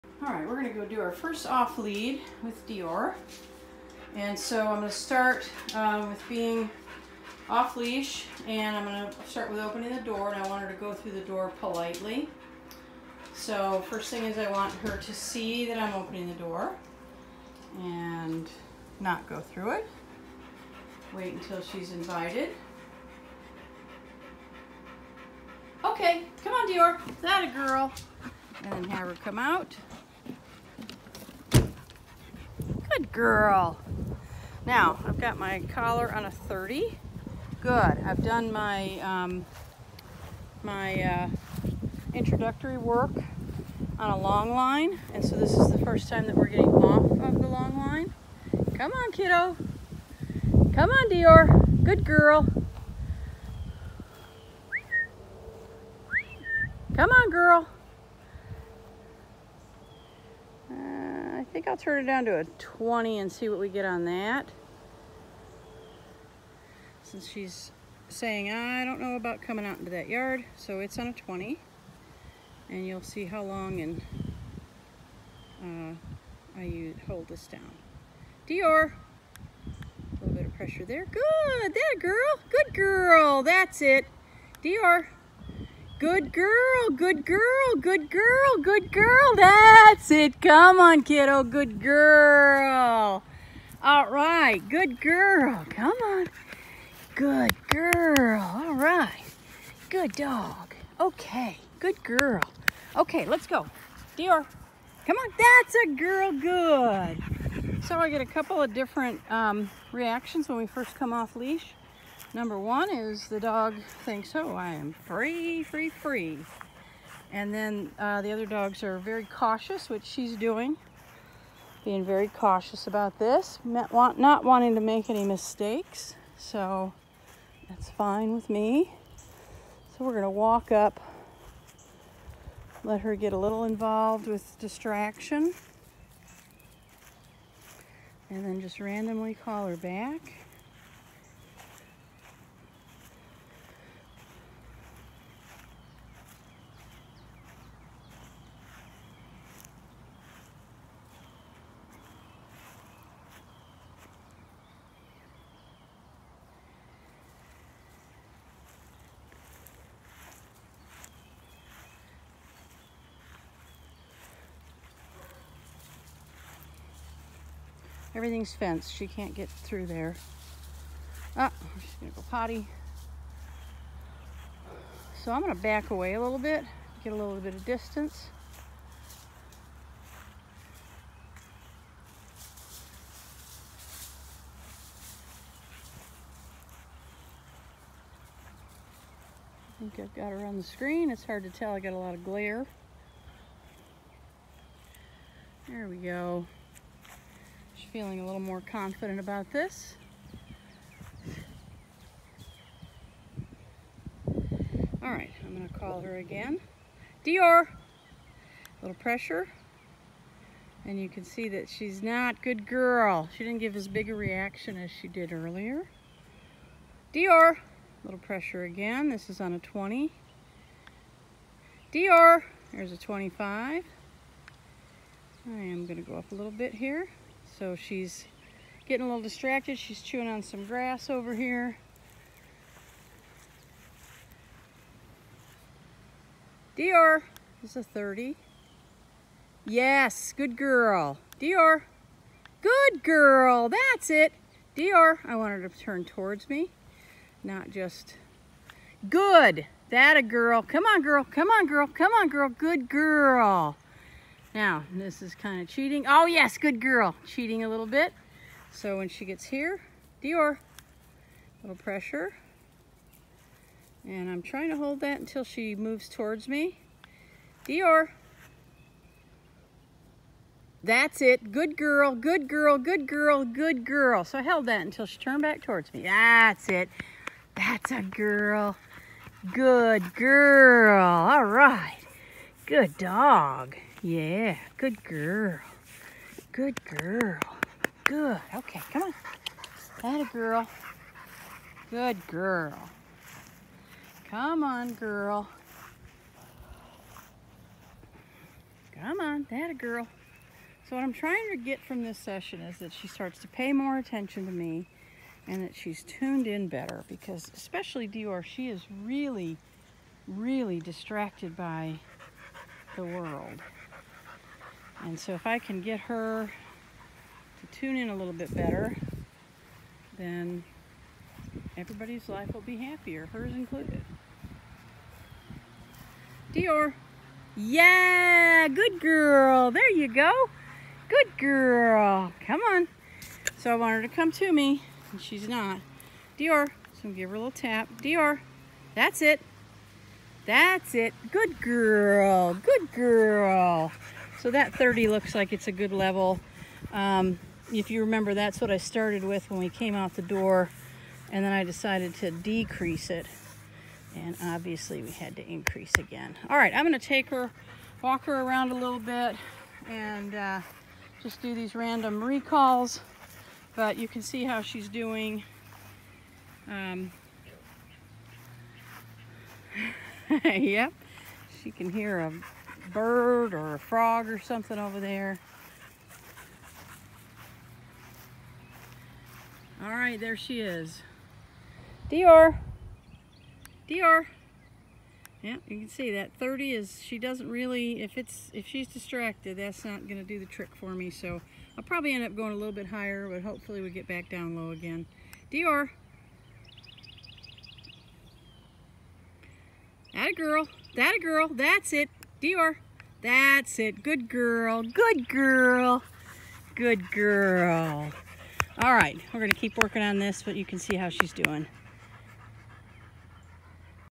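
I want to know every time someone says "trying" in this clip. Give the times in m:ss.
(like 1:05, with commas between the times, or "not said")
4:24, 5:01.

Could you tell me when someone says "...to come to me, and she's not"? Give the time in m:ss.
5:34.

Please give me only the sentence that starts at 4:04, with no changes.
Dior, I want her to turn towards me, not just, good, that a girl.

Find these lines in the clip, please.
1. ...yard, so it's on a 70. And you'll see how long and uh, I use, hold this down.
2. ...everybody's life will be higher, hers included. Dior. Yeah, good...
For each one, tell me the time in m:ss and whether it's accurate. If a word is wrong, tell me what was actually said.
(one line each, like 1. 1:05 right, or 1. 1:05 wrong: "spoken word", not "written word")
1. 1:10 wrong: "20", not "70"
2. 5:21 wrong: "happier", not "higher".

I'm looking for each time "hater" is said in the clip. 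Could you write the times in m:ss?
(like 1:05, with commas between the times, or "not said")
not said.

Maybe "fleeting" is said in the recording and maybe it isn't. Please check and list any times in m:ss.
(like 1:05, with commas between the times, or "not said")
not said.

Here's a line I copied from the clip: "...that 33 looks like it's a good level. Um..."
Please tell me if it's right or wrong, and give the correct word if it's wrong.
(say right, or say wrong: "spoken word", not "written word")
wrong: "30", not "33".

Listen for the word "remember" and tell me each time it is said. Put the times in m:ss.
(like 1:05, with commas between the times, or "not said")
5:48.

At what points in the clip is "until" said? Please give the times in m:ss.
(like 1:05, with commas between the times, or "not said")
0:21, 4:25, 4:34.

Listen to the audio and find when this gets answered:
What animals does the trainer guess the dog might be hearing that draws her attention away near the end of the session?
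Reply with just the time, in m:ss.
6:12.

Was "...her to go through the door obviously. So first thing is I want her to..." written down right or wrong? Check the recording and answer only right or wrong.
wrong.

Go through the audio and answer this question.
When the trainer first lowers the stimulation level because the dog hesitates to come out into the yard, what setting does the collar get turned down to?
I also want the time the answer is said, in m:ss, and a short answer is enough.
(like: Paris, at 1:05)
20, at 1:01.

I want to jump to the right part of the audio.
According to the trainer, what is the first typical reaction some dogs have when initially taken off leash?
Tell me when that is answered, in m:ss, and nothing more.
1:54.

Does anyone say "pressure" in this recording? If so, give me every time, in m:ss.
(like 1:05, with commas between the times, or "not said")
1:20, 3:28, 3:38, 4:21.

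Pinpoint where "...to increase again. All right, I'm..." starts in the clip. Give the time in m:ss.
5:55.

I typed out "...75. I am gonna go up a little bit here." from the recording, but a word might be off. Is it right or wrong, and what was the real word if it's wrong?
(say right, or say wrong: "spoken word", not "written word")
wrong: "25", not "75".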